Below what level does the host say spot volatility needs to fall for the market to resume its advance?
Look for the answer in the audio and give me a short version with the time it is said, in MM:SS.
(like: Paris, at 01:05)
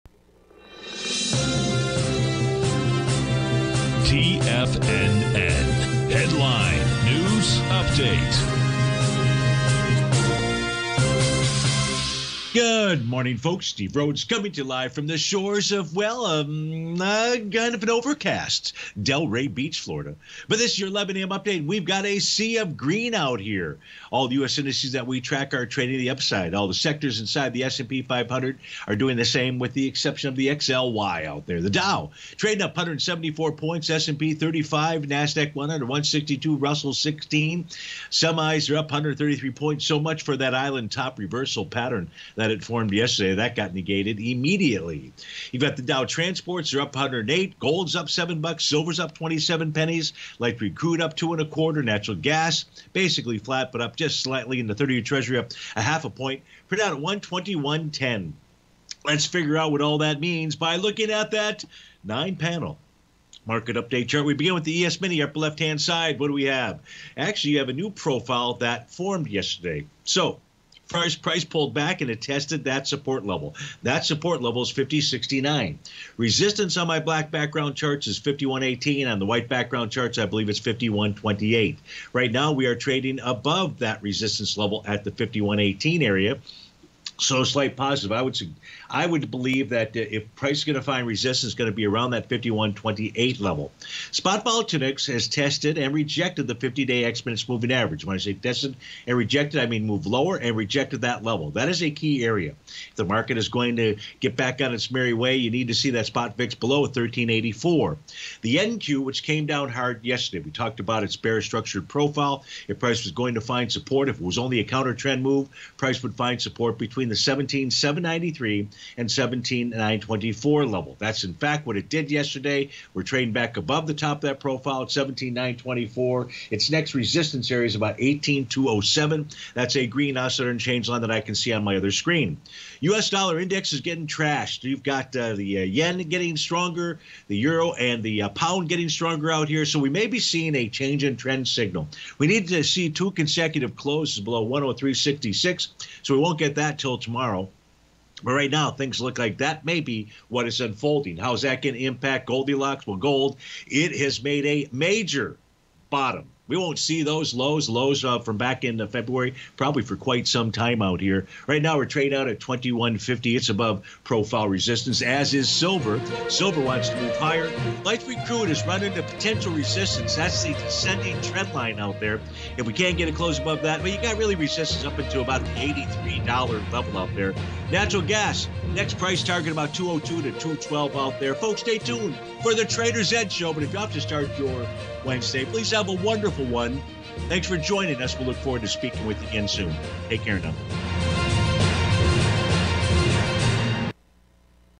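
13.84, at 01:46.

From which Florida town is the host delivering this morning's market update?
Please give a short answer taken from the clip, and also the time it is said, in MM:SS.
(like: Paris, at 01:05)
Delray Beach, at 00:19.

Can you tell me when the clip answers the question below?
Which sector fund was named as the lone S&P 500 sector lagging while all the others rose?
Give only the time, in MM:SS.
00:30.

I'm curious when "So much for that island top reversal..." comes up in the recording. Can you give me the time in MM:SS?
00:39.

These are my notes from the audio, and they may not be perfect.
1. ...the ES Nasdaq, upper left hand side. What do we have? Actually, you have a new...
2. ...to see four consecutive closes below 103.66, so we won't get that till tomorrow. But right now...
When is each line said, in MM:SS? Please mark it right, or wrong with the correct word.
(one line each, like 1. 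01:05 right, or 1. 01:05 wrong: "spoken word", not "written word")
1. 01:04 wrong: "Mini", not "Nasdaq"
2. 02:22 wrong: "two", not "four".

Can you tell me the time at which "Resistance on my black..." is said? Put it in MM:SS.
01:16.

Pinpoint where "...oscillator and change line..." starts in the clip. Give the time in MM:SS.
02:10.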